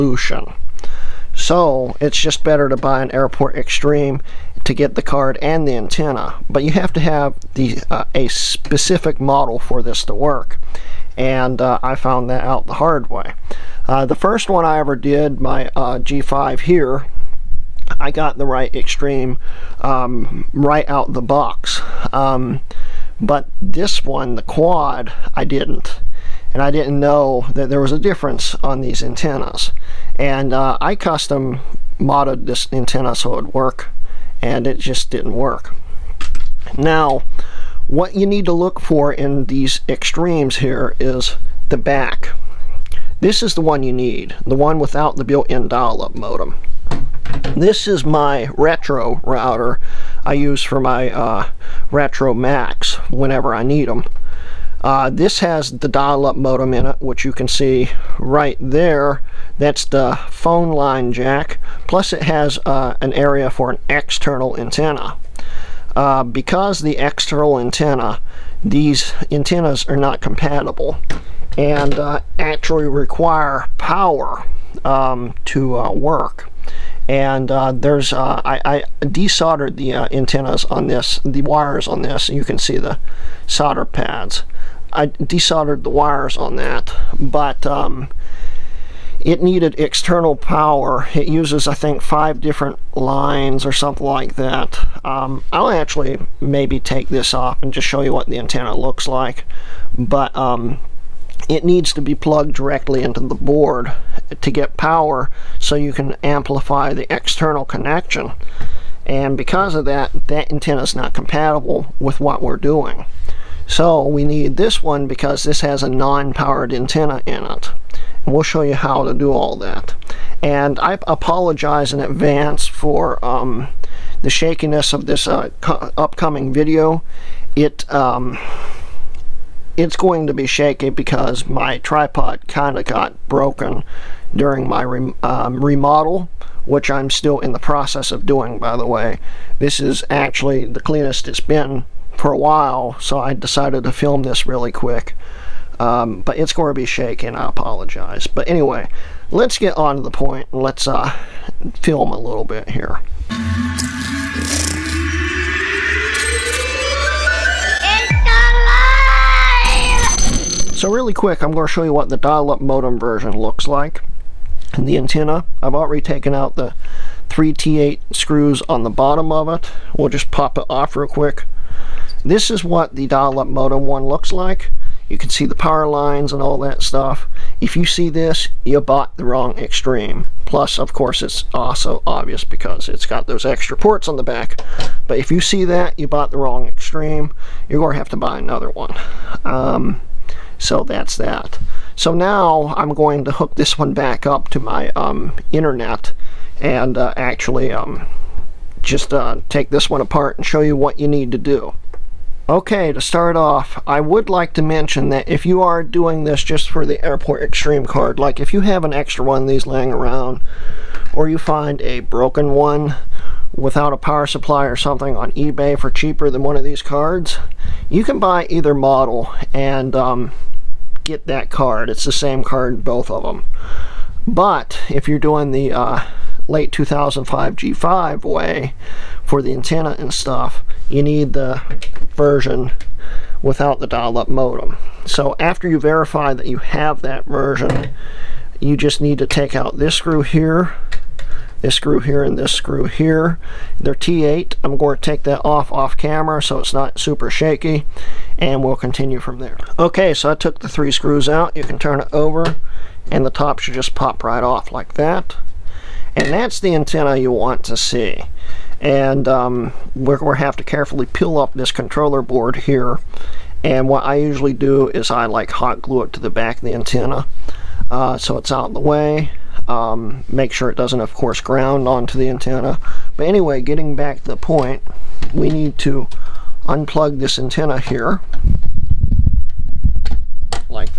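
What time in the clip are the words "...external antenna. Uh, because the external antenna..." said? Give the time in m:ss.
1:03.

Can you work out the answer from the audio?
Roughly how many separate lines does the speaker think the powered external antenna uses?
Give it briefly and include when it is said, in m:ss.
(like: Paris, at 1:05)
5, at 1:31.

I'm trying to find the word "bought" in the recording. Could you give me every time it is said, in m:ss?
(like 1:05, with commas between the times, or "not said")
2:58, 3:06.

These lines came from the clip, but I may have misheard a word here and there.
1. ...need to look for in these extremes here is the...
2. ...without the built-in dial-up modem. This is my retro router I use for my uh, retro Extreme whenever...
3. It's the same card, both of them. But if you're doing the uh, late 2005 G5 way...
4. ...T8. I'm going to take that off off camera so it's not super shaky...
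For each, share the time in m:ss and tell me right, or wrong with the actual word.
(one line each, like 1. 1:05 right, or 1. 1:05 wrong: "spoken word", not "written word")
1. 0:38 right
2. 0:44 wrong: "Macs", not "Extreme"
3. 3:41 right
4. 4:03 right.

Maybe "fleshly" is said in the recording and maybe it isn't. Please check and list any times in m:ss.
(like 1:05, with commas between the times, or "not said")
not said.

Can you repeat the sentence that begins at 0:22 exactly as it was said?
Um, but this one, the quad, I didn't.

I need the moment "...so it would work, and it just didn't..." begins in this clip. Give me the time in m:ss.
0:33.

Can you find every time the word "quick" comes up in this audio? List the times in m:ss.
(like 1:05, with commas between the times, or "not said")
2:24, 2:41, 2:51.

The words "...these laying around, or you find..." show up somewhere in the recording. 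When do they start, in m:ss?
3:29.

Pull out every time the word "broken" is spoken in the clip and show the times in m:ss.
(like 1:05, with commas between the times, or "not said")
2:13, 3:31.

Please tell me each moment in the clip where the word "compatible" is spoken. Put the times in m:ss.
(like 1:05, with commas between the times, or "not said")
1:10, 1:51.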